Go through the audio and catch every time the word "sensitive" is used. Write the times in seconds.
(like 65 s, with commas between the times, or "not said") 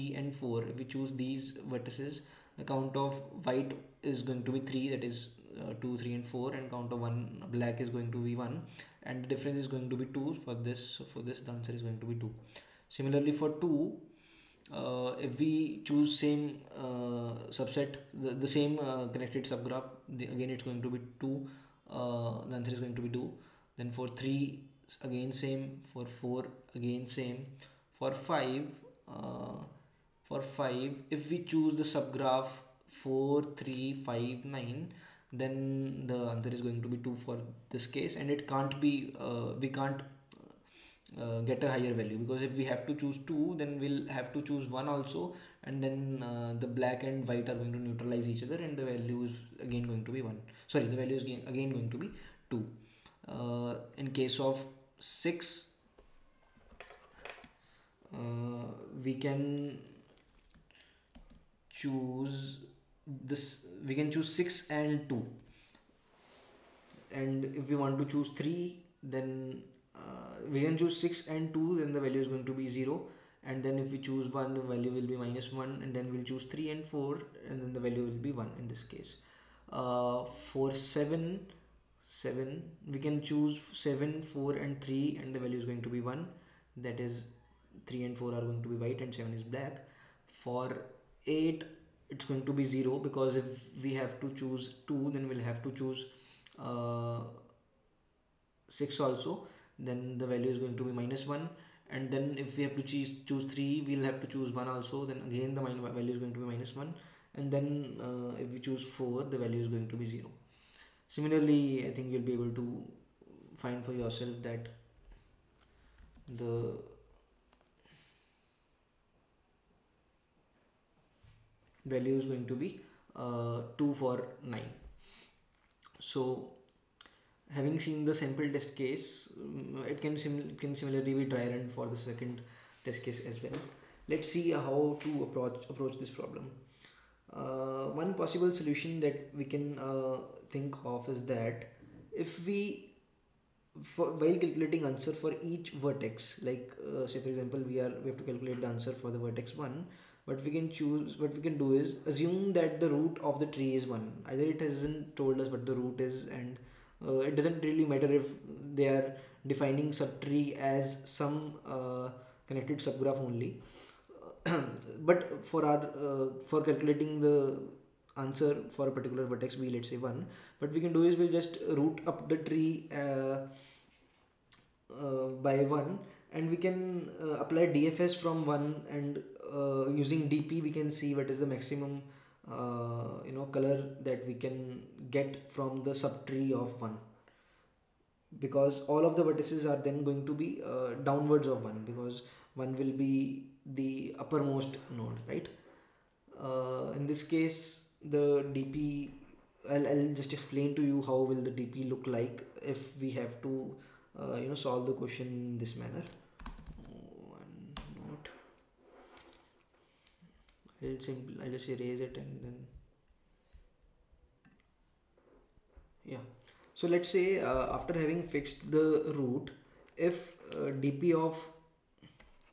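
not said.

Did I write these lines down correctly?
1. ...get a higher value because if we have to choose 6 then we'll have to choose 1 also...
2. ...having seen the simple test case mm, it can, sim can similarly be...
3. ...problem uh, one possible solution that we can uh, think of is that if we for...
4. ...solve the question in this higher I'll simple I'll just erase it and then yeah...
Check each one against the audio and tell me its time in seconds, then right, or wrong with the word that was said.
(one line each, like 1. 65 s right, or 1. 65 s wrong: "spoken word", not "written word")
1. 41 s wrong: "2", not "6"
2. 127 s wrong: "sample", not "simple"
3. 136 s right
4. 204 s wrong: "manner", not "higher".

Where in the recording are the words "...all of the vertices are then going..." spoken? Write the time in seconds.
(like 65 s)
188 s.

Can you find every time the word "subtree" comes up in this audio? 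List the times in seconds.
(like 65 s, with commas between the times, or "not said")
160 s, 186 s.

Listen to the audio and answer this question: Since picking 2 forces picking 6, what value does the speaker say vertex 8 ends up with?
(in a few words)
0.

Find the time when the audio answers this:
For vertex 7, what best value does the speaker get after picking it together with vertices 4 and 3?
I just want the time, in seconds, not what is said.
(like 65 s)
85 s.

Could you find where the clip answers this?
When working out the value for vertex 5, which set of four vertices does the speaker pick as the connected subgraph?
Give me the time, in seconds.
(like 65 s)
33 s.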